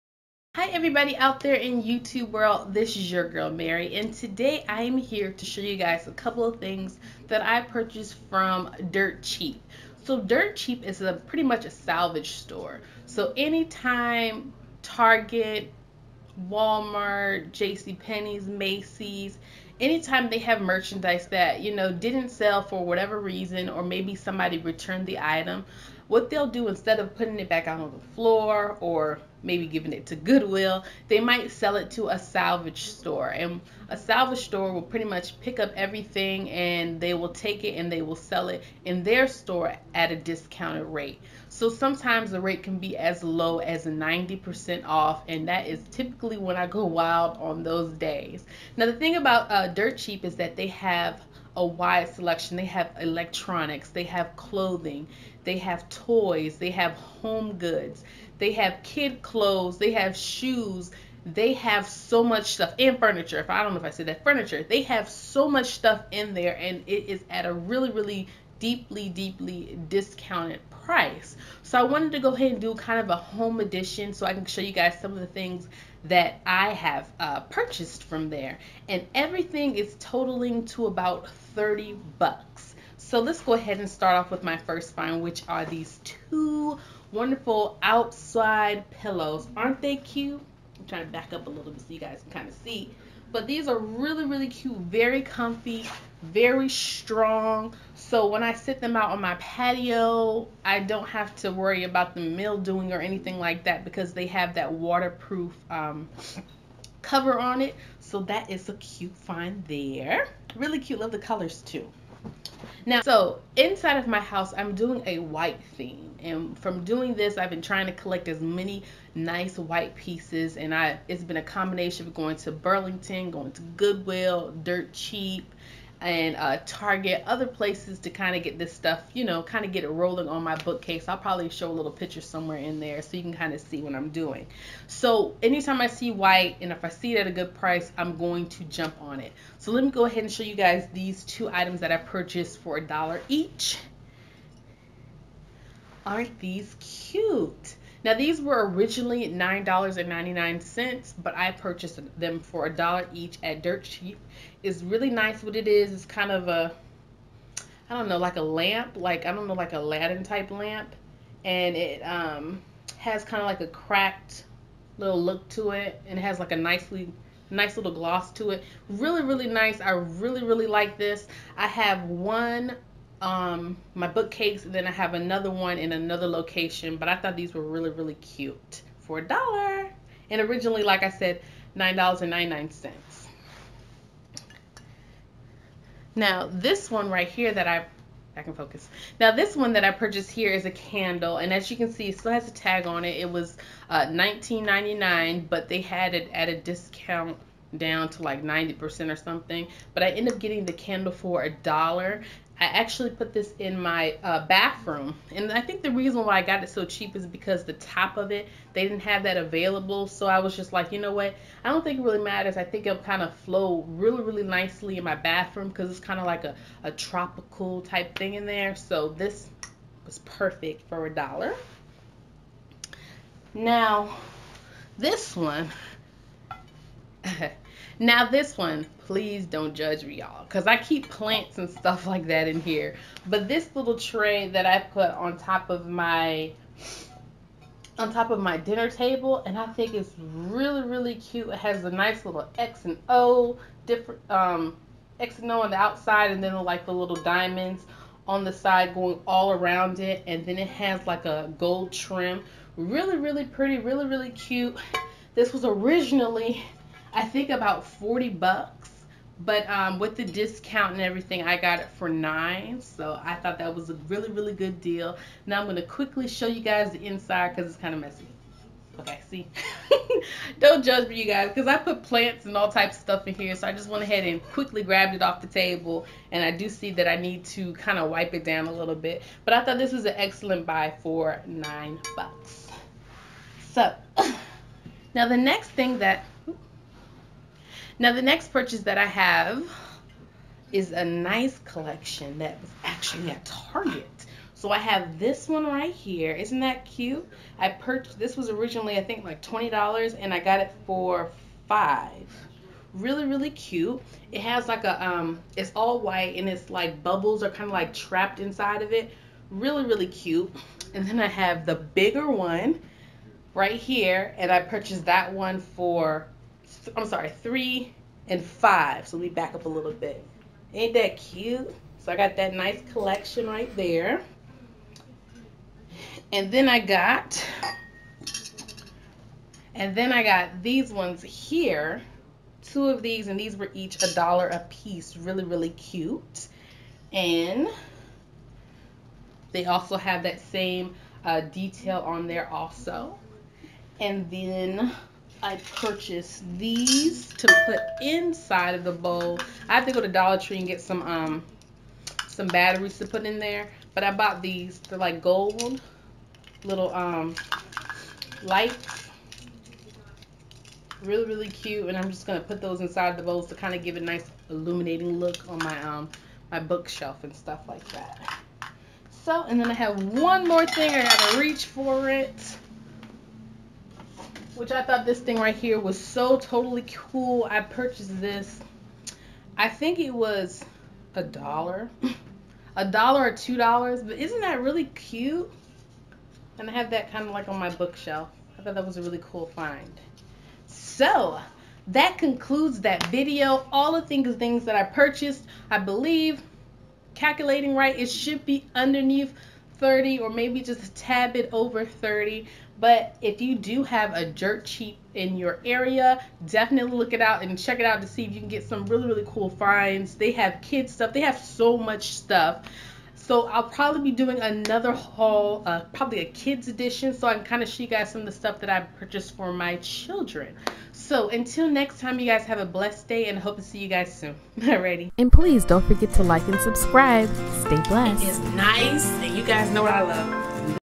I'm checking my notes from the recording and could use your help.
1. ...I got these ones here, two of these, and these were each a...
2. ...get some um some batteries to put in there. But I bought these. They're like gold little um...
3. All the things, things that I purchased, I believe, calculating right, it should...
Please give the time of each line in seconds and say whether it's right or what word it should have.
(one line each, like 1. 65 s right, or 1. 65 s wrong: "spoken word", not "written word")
1. 330 s right
2. 350 s right
3. 393 s right.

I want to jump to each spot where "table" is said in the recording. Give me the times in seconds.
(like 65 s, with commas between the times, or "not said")
238 s, 275 s.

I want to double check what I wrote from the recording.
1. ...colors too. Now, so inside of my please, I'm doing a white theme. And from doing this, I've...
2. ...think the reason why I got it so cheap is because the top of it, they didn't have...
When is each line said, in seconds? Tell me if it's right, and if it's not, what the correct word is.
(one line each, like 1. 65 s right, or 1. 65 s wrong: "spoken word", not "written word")
1. 111 s wrong: "house", not "please"
2. 205 s right.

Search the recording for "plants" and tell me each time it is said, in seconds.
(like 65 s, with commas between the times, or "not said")
231 s, 272 s.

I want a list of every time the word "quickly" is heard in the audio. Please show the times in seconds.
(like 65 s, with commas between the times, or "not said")
265 s, 274 s.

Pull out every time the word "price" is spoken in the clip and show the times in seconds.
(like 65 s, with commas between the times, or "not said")
70 s, 137 s.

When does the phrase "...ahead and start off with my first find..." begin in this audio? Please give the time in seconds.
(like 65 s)
83 s.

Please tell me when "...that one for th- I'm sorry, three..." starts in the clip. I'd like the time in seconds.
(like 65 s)
315 s.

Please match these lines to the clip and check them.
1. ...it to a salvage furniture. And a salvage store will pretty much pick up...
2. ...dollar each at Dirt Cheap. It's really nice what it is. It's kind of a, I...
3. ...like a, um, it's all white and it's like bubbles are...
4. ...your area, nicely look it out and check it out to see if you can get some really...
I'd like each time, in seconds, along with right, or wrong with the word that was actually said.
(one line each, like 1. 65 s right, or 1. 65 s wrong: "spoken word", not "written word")
1. 31 s wrong: "store", not "furniture"
2. 152 s right
3. 304 s right
4. 405 s wrong: "definitely", not "nicely".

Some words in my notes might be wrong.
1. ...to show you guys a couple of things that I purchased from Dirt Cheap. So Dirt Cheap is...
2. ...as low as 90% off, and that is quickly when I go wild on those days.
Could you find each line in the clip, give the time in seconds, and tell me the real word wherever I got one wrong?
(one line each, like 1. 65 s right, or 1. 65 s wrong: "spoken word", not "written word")
1. 5 s right
2. 42 s wrong: "typically", not "quickly".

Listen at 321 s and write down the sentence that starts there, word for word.
So I got that nice collection right there.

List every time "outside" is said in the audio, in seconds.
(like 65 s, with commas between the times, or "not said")
87 s, 245 s.